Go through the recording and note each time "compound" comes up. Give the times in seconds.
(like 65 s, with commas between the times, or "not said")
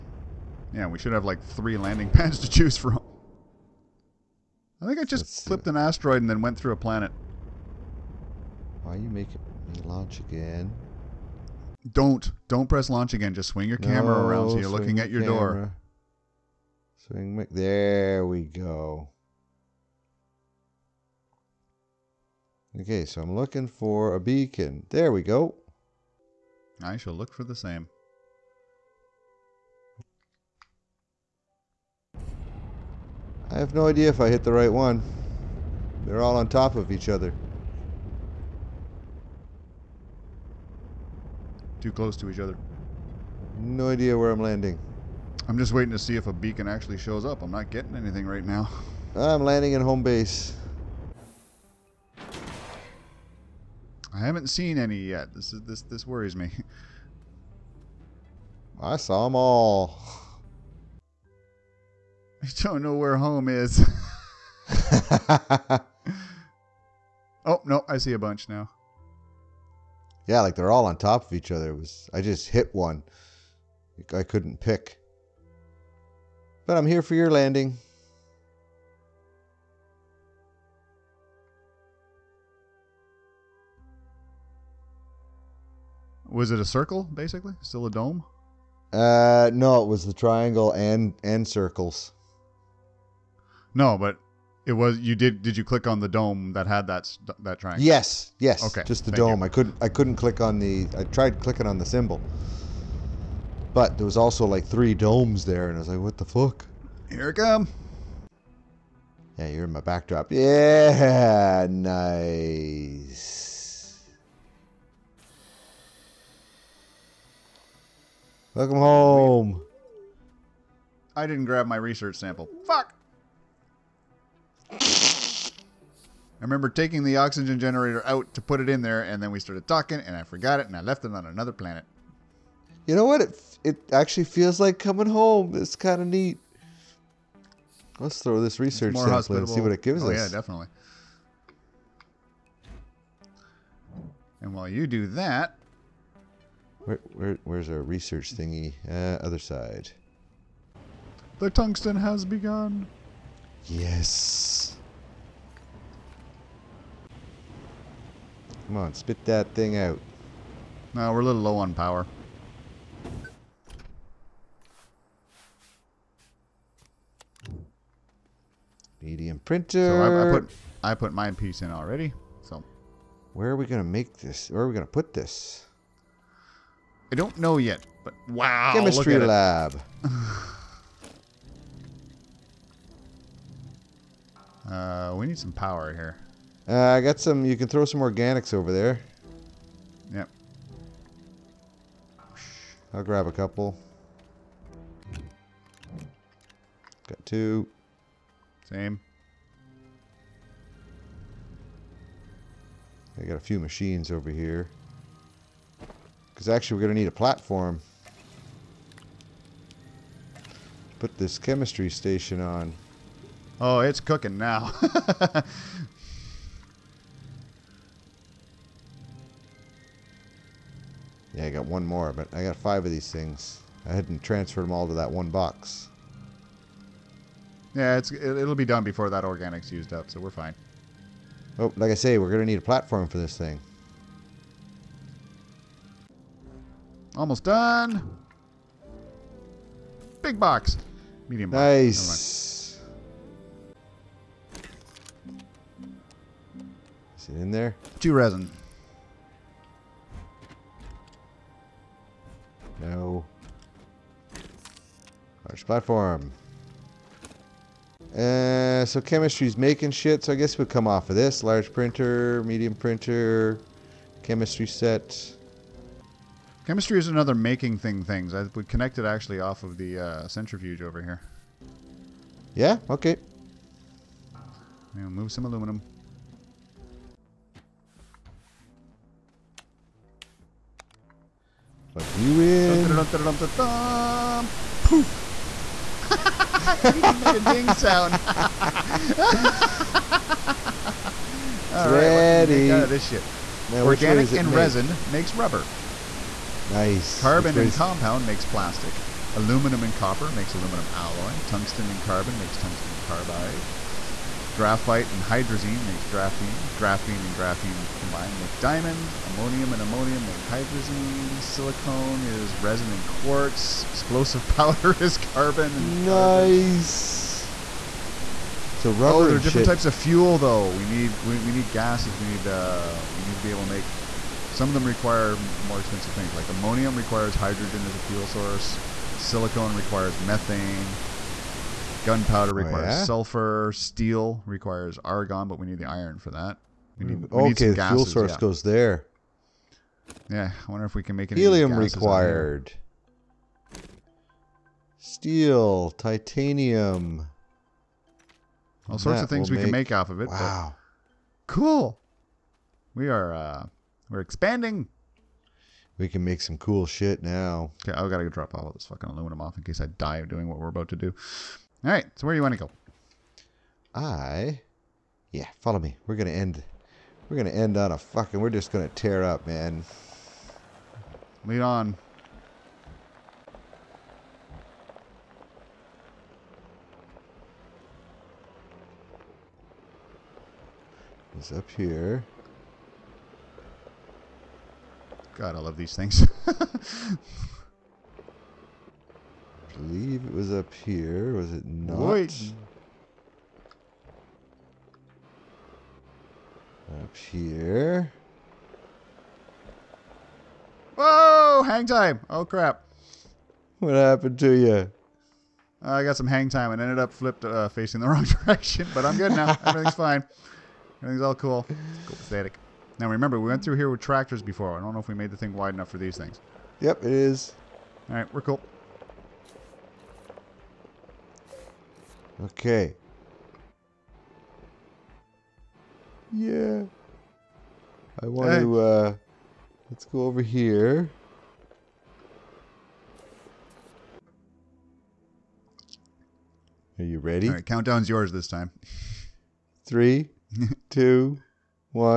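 297 s.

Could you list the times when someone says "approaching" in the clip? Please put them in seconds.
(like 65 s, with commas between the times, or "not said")
not said.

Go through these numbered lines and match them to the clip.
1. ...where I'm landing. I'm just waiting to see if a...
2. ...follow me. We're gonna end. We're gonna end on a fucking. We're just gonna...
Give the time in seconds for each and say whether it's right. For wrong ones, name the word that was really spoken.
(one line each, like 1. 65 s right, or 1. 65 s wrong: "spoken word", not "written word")
1. 44 s right
2. 365 s right.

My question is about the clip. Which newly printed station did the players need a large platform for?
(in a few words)
chemistry station.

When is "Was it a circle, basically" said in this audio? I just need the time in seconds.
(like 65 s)
86 s.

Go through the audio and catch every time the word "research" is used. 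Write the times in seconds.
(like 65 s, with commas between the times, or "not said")
121 s, 138 s, 147 s.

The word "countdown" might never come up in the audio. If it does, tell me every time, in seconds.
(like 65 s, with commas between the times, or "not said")
437 s.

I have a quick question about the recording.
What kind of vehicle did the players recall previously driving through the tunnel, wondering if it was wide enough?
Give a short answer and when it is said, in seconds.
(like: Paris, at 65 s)
tractors, at 413 s.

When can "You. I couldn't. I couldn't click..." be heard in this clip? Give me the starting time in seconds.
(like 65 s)
99 s.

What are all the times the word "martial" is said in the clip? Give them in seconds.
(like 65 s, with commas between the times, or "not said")
not said.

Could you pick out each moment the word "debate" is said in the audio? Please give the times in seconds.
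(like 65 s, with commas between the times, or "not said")
not said.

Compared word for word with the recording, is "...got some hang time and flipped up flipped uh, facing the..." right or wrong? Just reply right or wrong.
wrong.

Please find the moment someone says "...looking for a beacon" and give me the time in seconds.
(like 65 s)
23 s.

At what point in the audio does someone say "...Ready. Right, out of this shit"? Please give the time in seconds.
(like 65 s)
291 s.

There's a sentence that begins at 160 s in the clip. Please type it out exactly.
No, we're a little low on power.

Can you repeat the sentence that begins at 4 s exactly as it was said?
I think I just Let's flipped an asteroid and then went through a planet.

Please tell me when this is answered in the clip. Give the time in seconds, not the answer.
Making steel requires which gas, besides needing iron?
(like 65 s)
335 s.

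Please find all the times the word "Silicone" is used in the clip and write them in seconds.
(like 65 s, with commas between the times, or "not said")
311 s, 329 s.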